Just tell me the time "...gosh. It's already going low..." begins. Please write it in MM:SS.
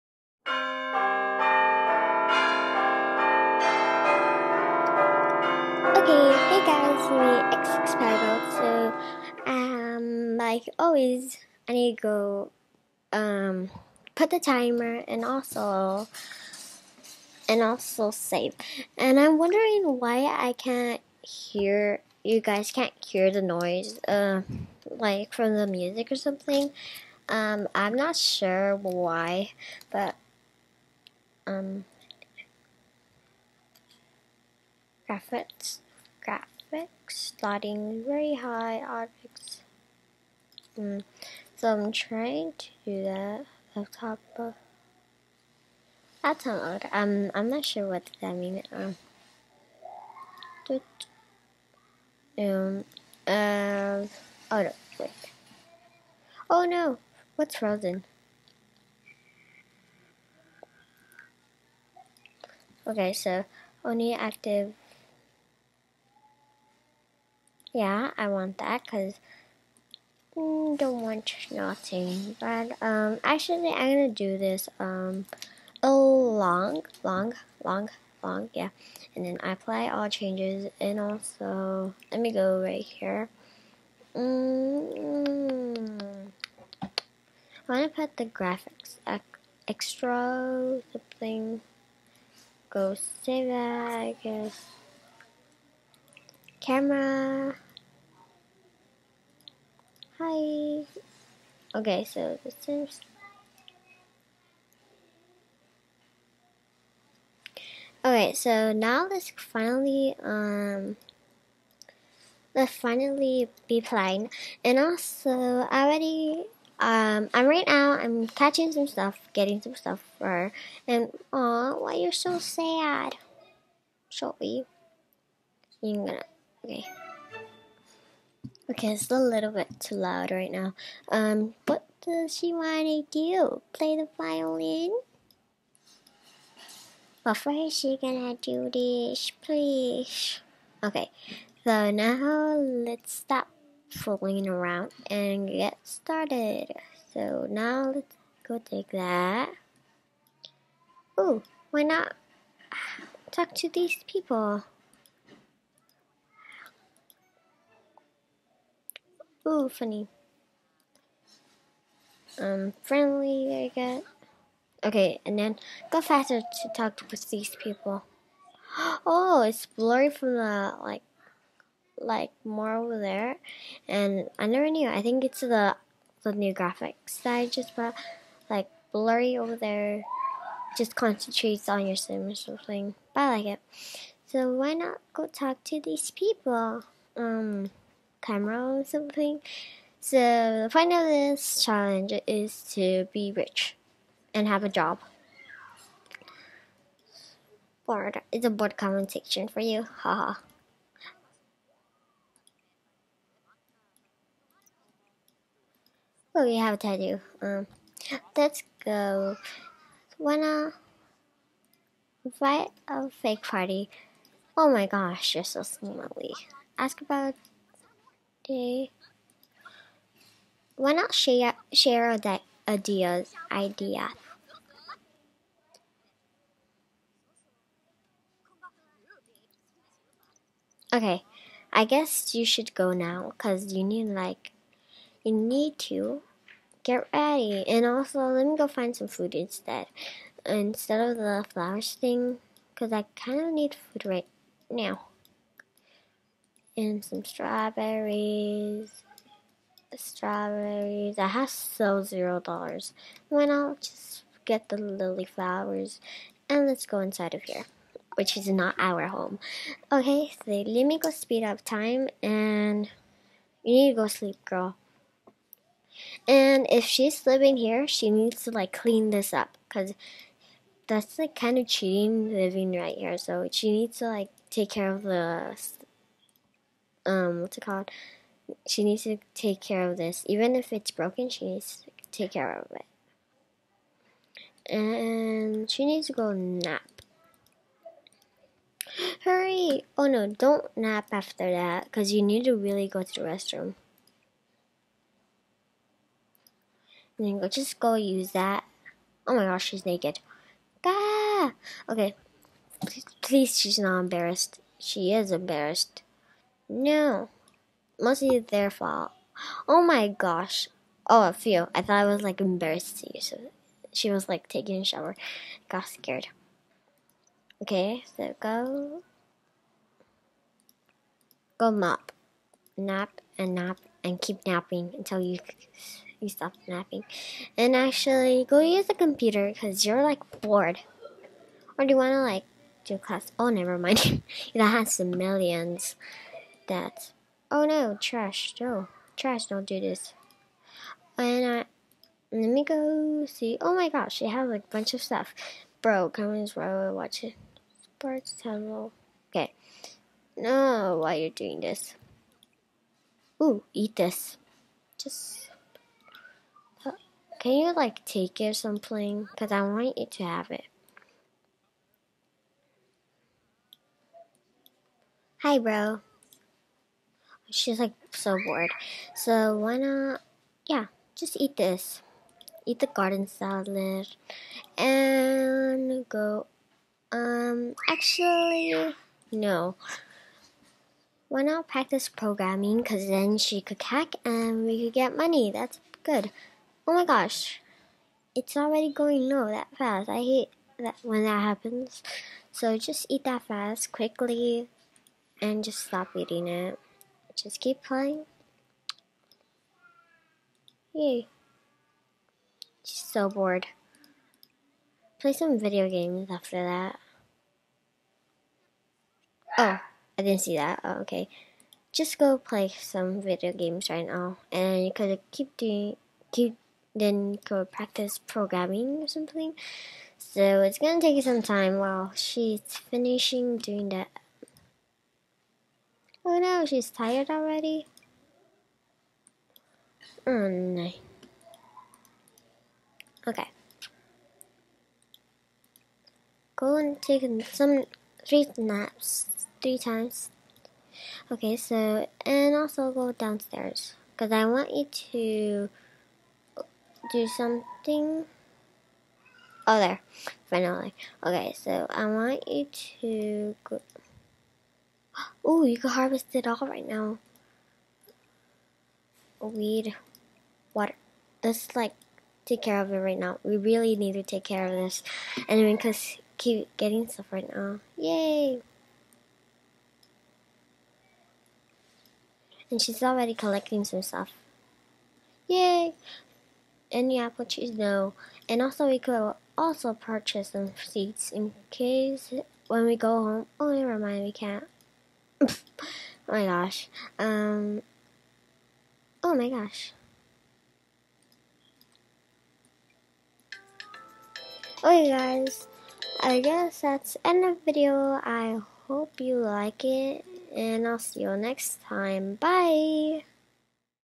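06:27.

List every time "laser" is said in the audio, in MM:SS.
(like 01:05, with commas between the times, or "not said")
not said.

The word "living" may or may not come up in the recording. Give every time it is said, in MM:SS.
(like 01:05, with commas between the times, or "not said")
04:27, 04:32.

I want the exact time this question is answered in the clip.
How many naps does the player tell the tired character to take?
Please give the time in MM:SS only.
07:19.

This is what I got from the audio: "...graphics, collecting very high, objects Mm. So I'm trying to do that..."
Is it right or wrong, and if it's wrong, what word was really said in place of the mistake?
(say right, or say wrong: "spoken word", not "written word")
wrong: "starting", not "collecting".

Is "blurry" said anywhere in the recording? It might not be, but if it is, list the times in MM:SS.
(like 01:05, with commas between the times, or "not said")
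02:49, 02:58.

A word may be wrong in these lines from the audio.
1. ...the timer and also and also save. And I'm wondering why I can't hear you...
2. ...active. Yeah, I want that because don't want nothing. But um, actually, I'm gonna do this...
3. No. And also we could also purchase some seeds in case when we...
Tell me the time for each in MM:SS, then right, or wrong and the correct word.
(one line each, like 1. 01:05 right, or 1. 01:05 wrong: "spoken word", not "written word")
1. 00:14 right
2. 01:04 right
3. 07:57 right.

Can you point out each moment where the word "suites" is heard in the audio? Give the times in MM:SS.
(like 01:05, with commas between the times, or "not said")
not said.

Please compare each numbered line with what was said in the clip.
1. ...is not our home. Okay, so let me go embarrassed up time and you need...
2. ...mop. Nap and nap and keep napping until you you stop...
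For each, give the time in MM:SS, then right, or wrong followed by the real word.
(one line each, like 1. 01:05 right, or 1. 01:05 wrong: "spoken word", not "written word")
1. 04:18 wrong: "speed", not "embarrassed"
2. 05:21 right.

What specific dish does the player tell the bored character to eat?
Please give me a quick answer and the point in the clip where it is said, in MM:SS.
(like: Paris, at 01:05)
Garden salad, at 06:12.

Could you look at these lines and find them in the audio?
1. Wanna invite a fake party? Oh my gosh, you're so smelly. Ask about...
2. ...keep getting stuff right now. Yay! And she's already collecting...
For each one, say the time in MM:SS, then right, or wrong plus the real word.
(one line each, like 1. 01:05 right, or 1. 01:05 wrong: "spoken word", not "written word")
1. 03:30 right
2. 07:46 right.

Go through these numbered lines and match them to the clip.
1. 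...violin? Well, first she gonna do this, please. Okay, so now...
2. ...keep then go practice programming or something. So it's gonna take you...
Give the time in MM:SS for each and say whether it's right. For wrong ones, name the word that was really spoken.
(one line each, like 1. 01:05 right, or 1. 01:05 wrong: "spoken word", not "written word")
1. 02:14 right
2. 06:56 right.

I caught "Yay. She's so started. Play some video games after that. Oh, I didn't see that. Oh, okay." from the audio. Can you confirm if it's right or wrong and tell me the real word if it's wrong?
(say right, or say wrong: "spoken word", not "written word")
wrong: "bored", not "started".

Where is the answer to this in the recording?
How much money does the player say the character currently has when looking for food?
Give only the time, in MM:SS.
04:12.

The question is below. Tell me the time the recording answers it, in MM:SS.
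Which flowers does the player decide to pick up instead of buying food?
04:14.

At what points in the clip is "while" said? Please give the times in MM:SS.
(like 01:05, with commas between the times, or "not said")
05:46, 07:01.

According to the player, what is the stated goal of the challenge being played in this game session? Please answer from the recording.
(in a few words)
To be rich and have a job.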